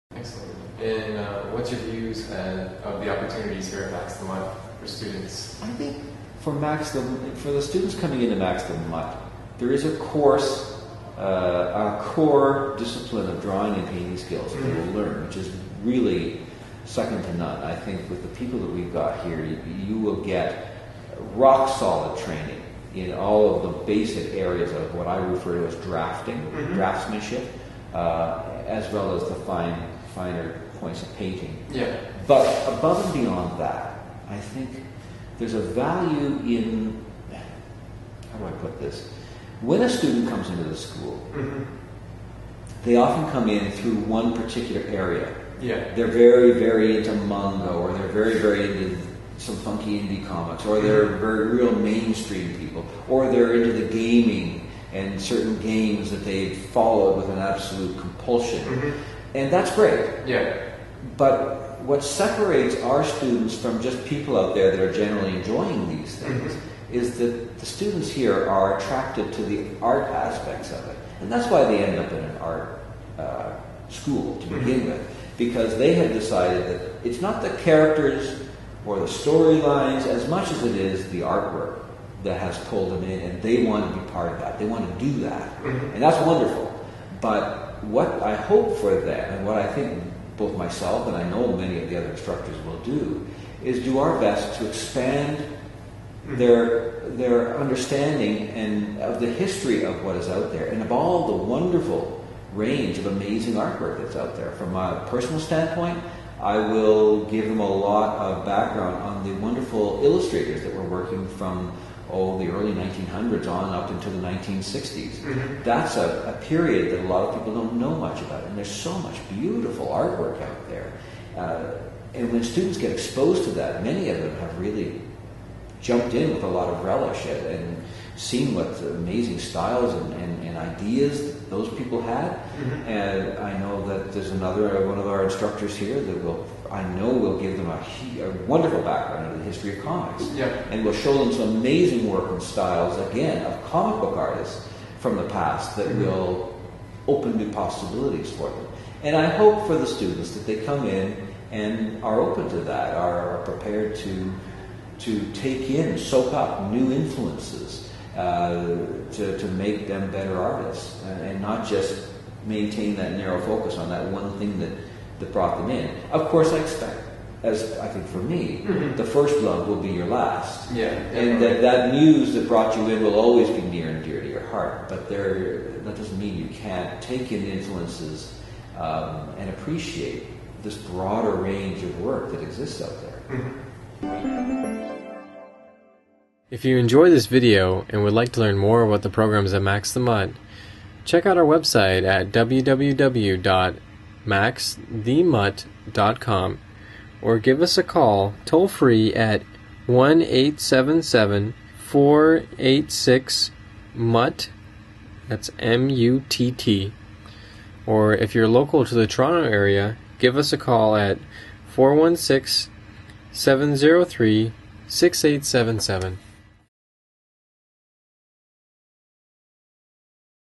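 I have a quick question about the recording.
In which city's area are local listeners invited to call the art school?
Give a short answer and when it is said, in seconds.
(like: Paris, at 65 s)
Toronto, at 209 s.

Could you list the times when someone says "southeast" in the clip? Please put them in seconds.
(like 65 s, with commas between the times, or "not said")
not said.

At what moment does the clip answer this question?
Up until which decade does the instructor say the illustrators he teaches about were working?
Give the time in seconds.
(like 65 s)
114 s.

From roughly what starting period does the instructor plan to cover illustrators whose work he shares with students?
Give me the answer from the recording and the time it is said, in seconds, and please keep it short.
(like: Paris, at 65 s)
Early 1900s, at 112 s.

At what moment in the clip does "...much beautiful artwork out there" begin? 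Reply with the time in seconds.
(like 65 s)
118 s.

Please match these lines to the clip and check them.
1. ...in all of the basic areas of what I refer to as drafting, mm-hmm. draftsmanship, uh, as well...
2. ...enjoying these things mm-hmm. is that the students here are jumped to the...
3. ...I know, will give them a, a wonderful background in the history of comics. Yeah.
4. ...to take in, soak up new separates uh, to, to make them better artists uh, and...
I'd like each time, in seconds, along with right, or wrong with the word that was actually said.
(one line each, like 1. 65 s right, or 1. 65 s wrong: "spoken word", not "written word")
1. 22 s right
2. 65 s wrong: "attracted", not "jumped"
3. 136 s right
4. 155 s wrong: "influences", not "separates".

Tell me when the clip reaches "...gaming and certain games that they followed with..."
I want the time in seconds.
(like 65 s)
53 s.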